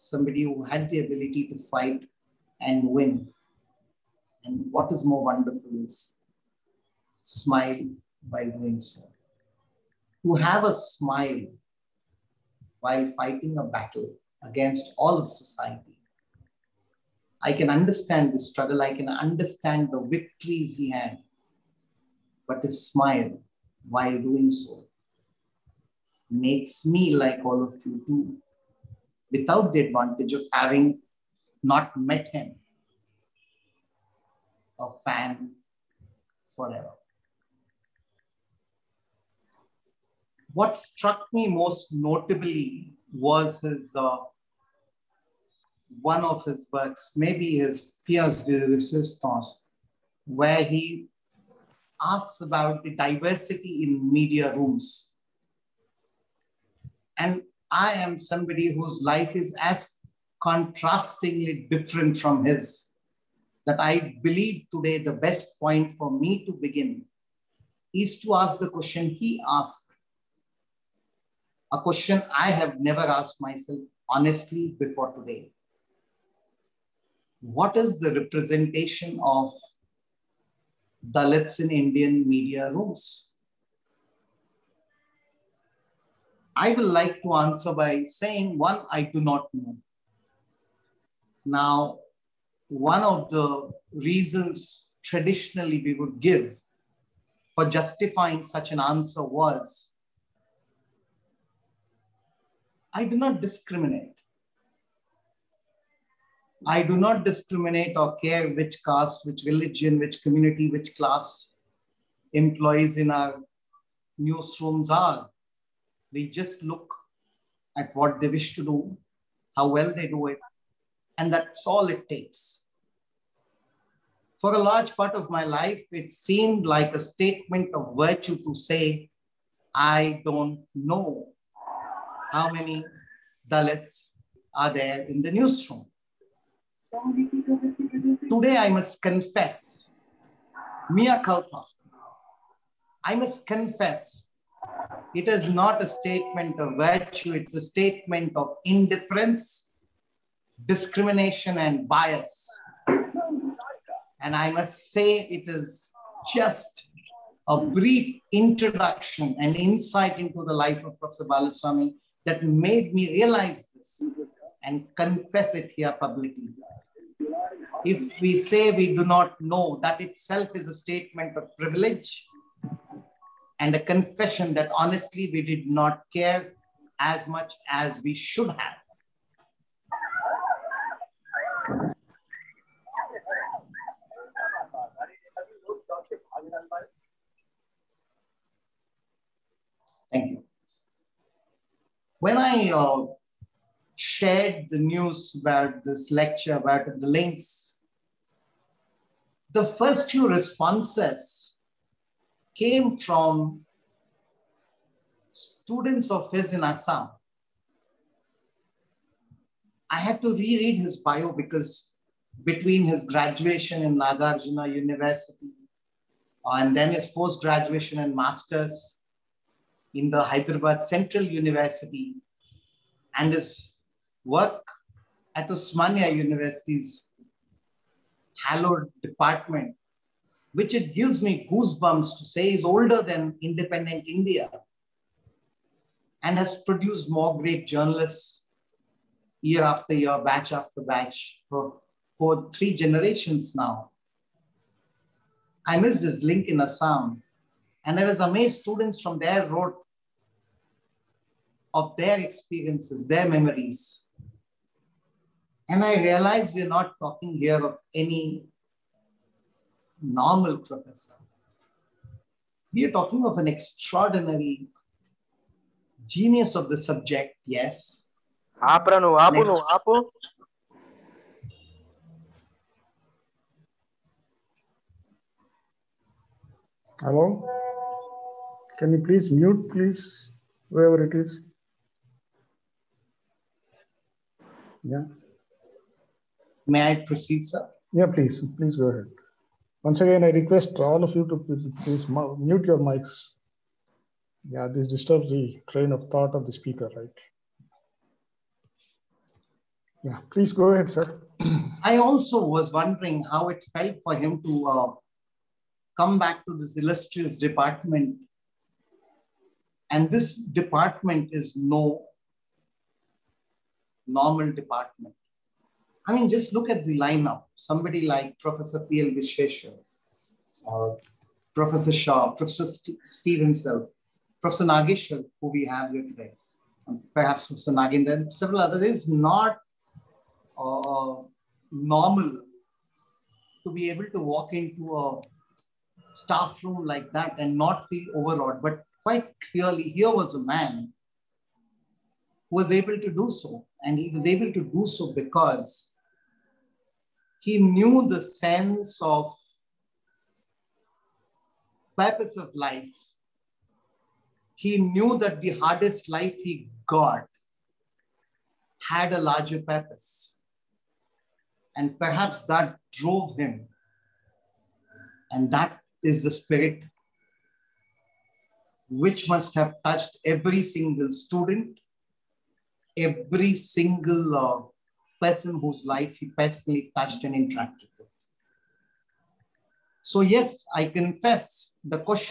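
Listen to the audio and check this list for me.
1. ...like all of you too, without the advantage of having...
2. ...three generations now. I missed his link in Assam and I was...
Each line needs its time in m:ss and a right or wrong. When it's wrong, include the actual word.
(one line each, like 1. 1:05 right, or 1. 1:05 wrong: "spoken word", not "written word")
1. 0:27 right
2. 4:02 right.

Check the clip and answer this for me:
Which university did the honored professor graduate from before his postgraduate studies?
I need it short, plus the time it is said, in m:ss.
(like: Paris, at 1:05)
Nagarjuna University, at 3:33.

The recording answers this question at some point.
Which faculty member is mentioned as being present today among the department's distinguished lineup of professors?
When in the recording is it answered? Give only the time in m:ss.
5:24.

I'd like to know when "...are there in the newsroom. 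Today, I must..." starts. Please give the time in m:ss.
2:14.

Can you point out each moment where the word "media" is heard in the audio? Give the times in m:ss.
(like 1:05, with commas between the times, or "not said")
0:54, 1:22.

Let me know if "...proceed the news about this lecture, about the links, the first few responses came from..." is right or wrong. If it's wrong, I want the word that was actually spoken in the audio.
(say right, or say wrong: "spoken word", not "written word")
wrong: "shared", not "proceed".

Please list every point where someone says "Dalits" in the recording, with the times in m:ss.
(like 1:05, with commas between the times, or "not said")
1:21, 2:13.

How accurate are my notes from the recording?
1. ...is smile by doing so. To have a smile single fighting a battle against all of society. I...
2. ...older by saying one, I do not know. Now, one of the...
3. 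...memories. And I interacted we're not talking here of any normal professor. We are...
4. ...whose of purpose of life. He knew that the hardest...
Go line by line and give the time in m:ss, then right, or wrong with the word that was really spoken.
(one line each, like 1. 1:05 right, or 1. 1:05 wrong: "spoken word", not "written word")
1. 0:05 wrong: "while", not "single"
2. 1:27 wrong: "answer", not "older"
3. 4:13 wrong: "realized", not "interacted"
4. 5:48 wrong: "sense", not "whose".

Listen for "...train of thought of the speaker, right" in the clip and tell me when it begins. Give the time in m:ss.
4:55.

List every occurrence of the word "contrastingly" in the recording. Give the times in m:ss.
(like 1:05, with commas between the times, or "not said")
1:00.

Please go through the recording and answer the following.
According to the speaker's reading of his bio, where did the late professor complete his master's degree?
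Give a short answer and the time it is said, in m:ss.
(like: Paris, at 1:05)
Hyderabad Central University, at 3:40.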